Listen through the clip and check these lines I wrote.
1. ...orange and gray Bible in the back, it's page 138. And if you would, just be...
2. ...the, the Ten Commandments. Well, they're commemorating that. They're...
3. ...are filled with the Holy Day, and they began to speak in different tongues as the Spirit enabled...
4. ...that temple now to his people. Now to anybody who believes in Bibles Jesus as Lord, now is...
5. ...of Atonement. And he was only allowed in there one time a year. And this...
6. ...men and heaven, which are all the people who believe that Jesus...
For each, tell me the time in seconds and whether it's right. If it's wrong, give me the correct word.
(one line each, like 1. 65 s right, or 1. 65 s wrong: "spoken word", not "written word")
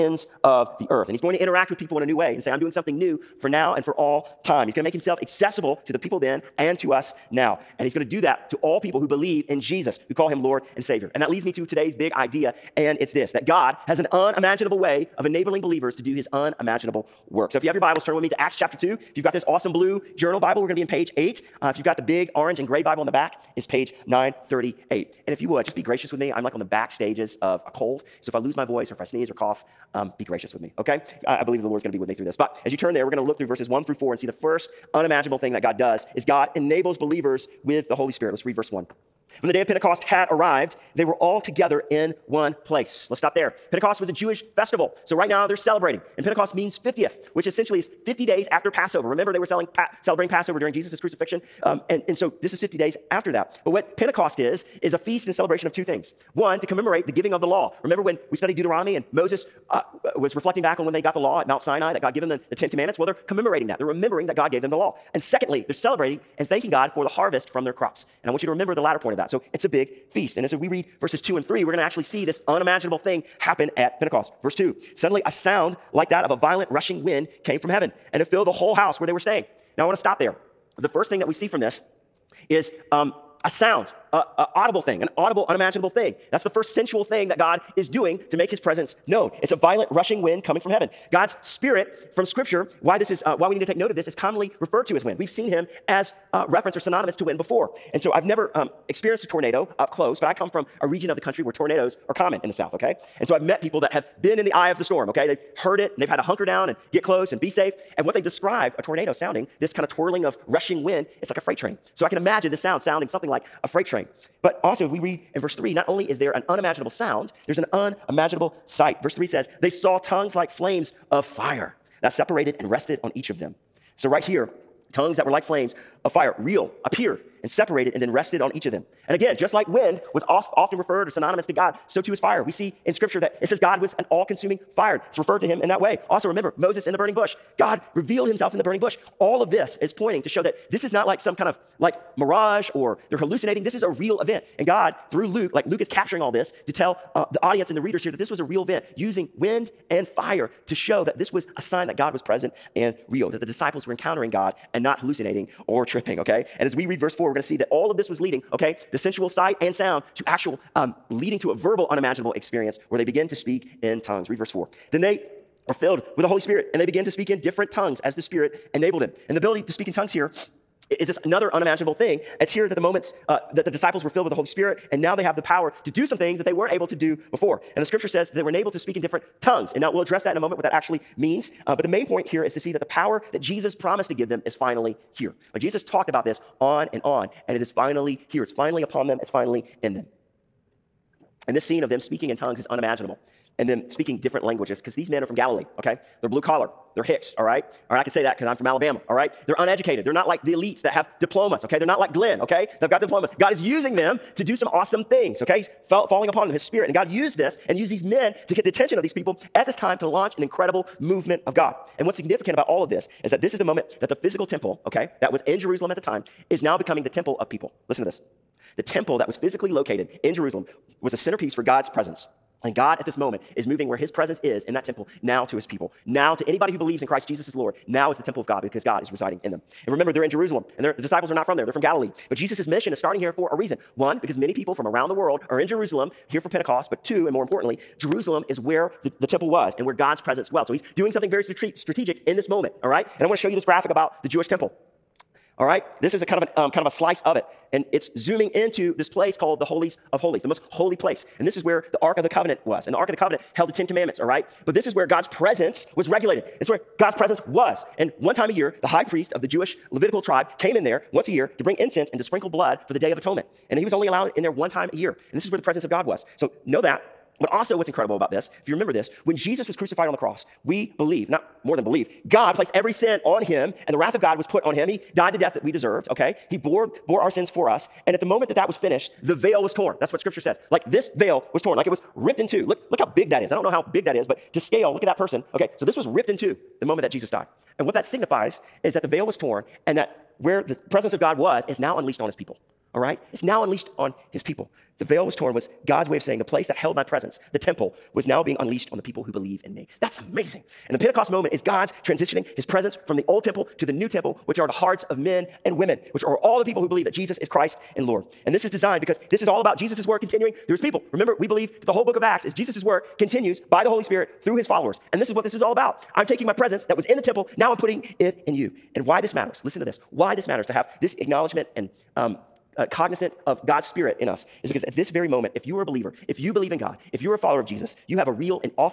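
1. 22 s wrong: "938", not "138"
2. 62 s right
3. 165 s wrong: "Spirit", not "Day"
4. 224 s wrong: "Christ", not "Bibles"
5. 263 s right
6. 305 s wrong: "women", not "heaven".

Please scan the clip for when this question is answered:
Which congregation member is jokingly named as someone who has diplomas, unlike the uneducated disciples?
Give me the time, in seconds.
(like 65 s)
202 s.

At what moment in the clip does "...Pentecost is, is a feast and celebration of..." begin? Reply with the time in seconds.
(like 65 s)
53 s.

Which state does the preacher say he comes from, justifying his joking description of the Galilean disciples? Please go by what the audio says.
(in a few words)
Alabama.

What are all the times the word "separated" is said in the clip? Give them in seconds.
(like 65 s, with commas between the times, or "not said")
122 s, 127 s.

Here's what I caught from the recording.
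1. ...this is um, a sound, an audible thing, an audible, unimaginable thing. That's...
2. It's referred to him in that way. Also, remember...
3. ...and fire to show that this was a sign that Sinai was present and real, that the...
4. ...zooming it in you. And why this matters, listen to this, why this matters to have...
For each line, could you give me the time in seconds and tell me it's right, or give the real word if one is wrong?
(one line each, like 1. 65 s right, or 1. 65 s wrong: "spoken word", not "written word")
1. 81 s right
2. 135 s right
3. 149 s wrong: "God", not "Sinai"
4. 317 s wrong: "putting", not "zooming".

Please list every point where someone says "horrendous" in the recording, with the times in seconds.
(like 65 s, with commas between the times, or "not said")
not said.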